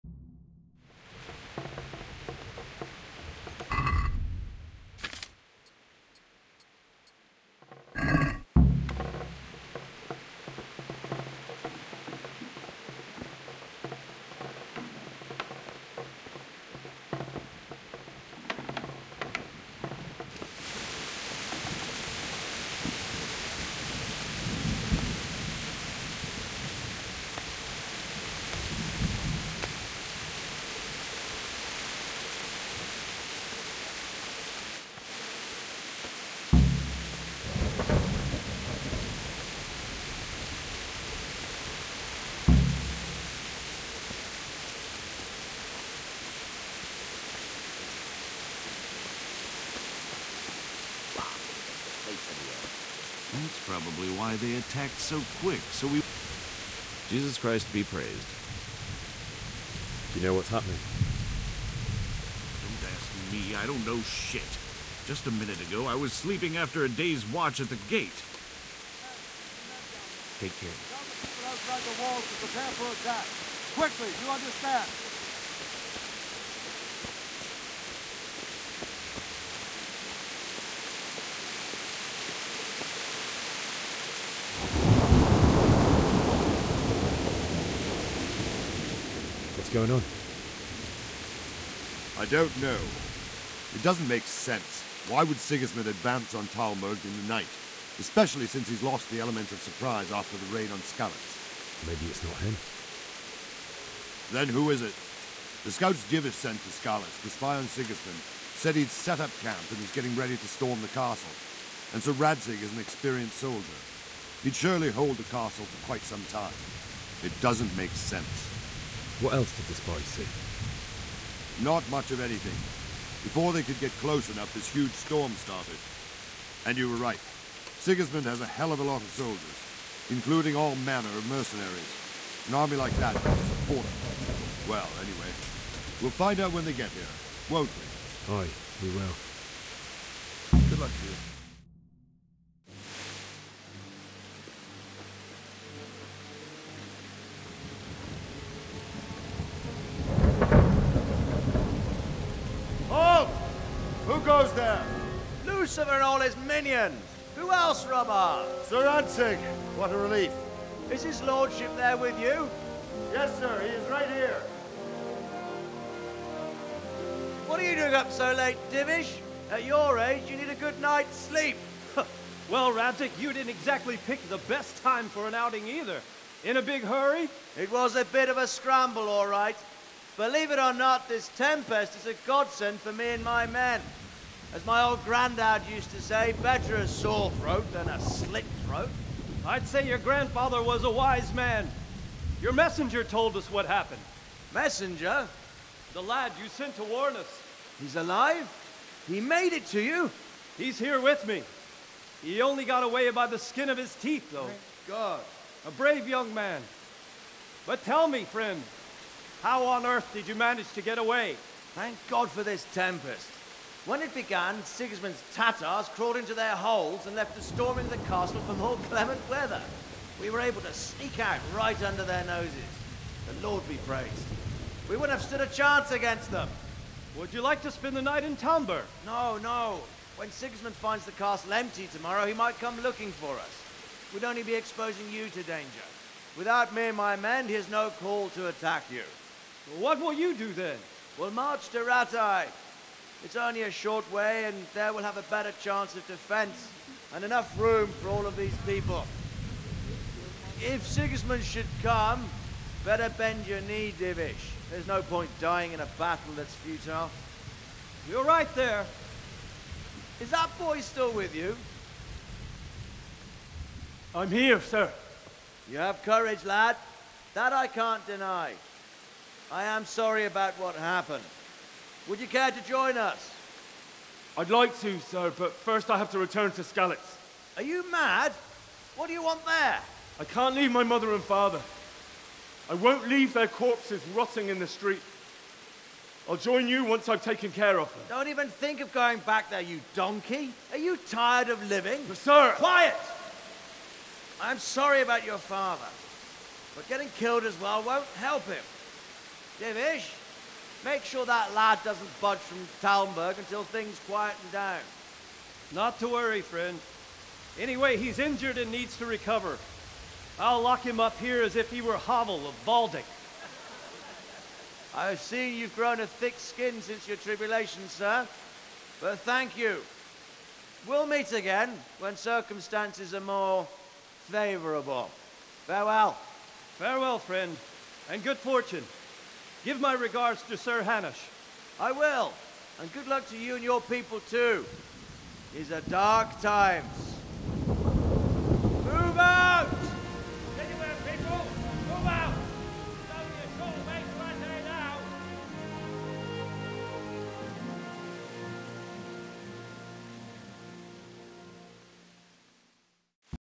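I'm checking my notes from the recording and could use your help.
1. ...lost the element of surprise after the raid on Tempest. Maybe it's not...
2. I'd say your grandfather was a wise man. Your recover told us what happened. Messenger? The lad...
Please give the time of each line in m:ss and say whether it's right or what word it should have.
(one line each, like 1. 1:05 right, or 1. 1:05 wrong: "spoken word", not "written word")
1. 1:38 wrong: "Skalitz", not "Tempest"
2. 3:09 wrong: "messenger", not "recover".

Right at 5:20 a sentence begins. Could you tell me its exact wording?
We'll meet again when circumstances are more favourable.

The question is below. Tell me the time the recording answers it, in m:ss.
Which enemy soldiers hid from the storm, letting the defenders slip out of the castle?
3:35.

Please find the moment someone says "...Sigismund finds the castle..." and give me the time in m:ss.
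3:50.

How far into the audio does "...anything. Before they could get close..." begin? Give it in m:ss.
2:02.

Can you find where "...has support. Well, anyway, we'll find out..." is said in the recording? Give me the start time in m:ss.
2:13.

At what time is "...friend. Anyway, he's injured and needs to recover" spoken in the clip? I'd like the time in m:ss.
5:06.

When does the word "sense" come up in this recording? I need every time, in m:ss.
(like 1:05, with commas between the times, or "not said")
1:34, 1:57.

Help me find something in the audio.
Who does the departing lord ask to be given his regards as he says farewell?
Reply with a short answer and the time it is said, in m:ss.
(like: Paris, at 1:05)
Sir Hanush, at 5:30.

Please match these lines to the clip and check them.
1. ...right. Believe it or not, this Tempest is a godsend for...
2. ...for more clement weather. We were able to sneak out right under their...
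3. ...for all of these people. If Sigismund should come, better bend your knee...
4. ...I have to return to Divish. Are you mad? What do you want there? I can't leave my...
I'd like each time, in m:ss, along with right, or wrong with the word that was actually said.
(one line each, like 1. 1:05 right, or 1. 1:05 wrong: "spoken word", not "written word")
1. 2:59 right
2. 3:38 right
3. 4:08 right
4. 4:35 wrong: "Skalitz", not "Divish".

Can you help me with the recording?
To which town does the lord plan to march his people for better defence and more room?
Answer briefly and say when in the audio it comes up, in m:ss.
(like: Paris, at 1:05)
Rattay, at 4:01.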